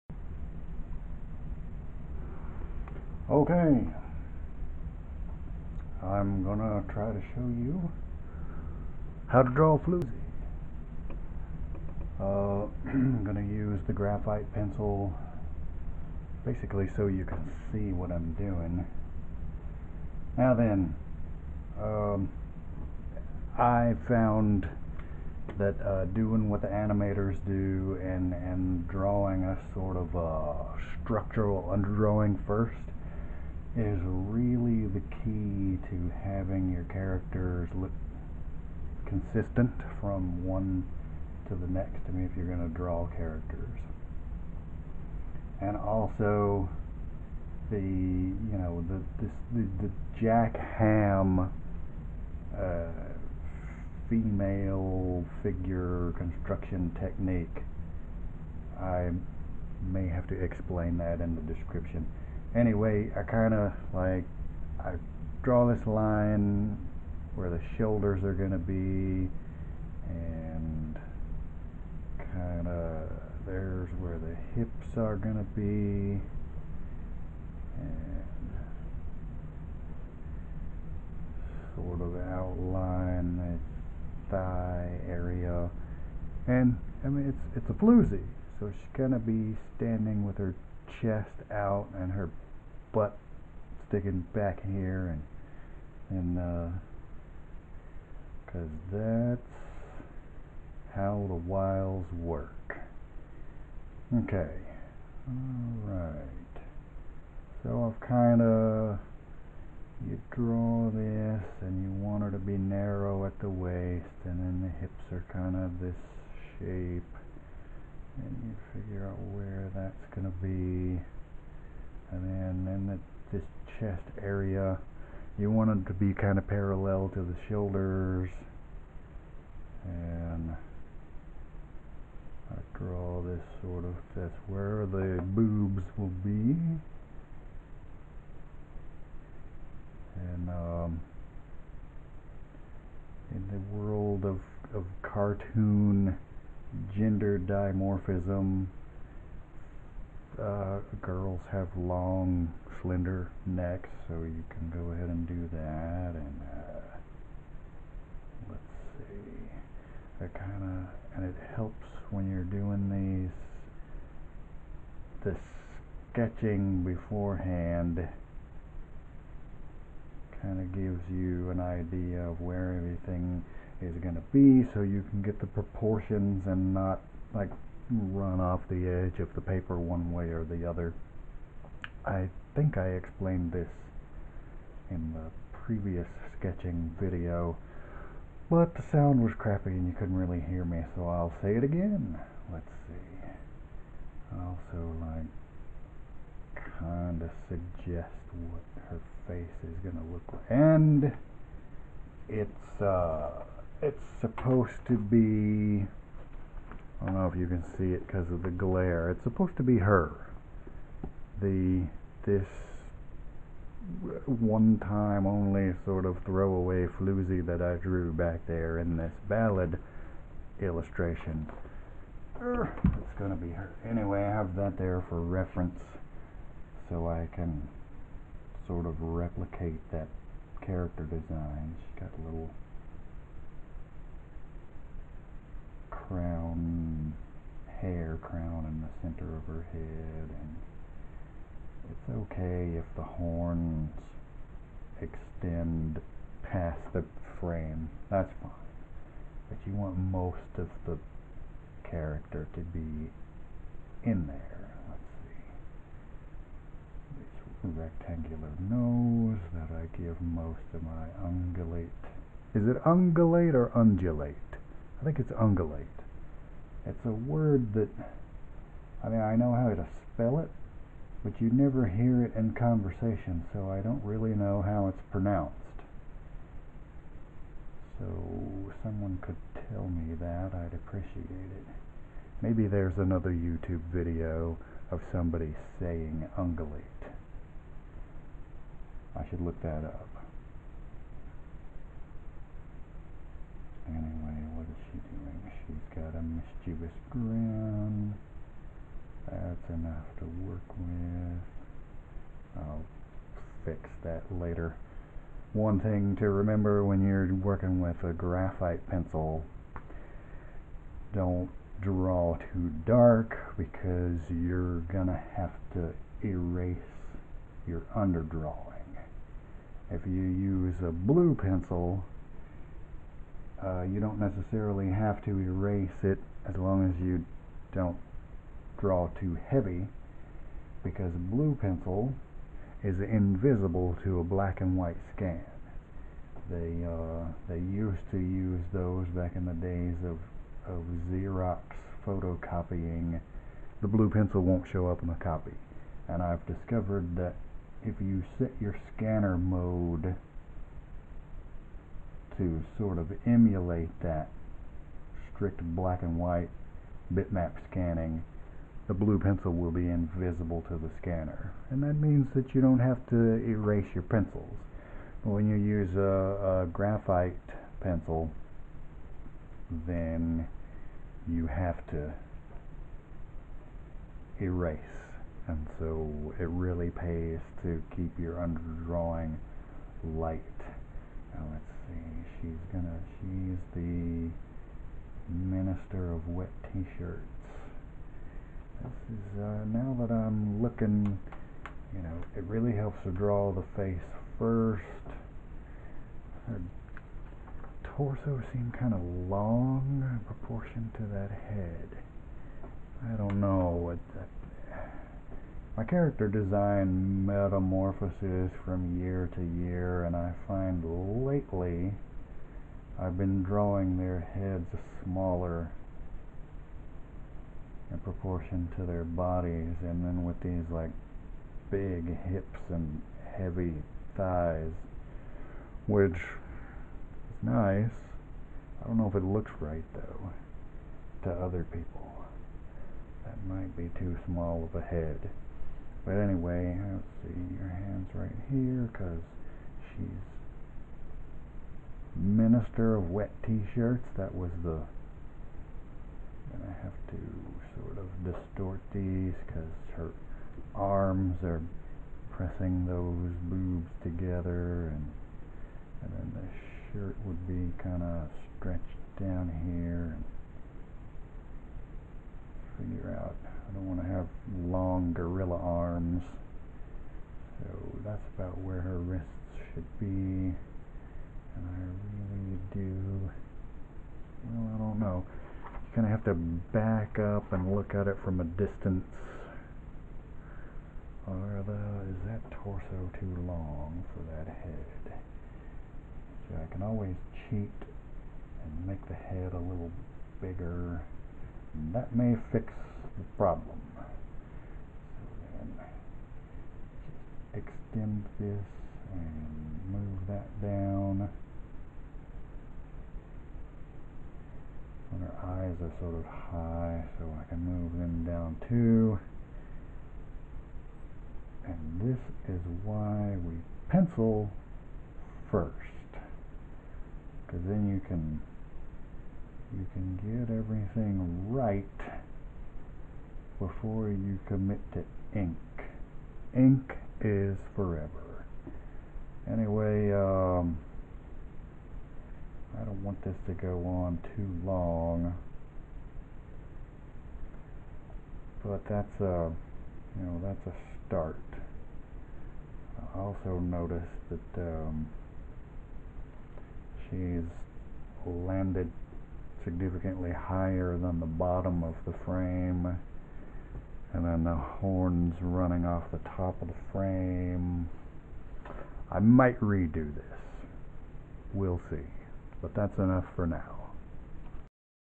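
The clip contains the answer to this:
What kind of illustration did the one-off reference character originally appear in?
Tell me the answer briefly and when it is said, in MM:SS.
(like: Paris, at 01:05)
ballad illustration, at 03:39.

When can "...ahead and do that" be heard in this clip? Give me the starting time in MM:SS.
02:34.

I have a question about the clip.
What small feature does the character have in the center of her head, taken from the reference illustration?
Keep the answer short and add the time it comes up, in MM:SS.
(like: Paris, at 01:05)
hair crown, at 03:57.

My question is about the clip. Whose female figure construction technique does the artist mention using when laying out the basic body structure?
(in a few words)
Jack Hamm.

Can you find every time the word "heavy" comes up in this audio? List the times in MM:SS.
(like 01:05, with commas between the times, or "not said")
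05:29, 07:03.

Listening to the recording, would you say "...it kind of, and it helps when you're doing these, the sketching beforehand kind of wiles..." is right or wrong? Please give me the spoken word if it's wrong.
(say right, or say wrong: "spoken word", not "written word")
wrong: "gives", not "wiles".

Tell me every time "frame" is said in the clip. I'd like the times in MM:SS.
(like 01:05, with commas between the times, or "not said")
04:07, 09:12, 09:16.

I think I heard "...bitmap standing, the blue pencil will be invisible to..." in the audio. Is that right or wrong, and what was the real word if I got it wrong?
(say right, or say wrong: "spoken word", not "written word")
wrong: "scanning", not "standing".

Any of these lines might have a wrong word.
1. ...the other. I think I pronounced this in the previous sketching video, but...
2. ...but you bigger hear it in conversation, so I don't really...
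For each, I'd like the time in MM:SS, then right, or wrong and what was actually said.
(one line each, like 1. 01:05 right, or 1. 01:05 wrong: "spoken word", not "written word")
1. 03:00 wrong: "explained", not "pronounced"
2. 04:31 wrong: "never", not "bigger".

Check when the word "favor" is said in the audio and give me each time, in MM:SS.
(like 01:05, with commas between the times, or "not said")
not said.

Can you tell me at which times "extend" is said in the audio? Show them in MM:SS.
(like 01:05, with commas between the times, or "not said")
04:05, 08:17.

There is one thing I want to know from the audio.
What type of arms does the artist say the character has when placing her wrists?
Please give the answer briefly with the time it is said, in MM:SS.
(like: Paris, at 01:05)
gorilla arms, at 07:45.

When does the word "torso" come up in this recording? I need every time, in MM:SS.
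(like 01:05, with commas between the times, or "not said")
06:37, 08:02.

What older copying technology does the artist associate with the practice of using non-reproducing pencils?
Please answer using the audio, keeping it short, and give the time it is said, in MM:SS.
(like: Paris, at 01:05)
Xerox photocopying, at 05:41.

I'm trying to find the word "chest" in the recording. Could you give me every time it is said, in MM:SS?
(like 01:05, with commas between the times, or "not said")
01:31, 02:03.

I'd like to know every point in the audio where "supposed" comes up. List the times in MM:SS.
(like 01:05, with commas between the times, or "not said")
03:24, 03:29.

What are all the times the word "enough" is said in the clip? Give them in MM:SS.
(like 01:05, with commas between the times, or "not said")
04:59, 09:22.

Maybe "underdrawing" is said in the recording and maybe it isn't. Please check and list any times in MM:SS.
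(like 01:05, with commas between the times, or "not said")
00:31, 05:17, 06:18.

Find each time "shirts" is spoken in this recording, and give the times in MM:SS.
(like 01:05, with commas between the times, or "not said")
06:26, 07:23, 07:36.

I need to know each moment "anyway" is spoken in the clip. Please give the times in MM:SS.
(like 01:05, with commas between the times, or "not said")
01:02, 03:43, 04:53, 07:16, 08:49.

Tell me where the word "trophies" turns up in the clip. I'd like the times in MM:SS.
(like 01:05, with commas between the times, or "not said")
not said.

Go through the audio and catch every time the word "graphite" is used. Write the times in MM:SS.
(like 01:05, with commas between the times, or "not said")
00:13, 05:08, 06:06.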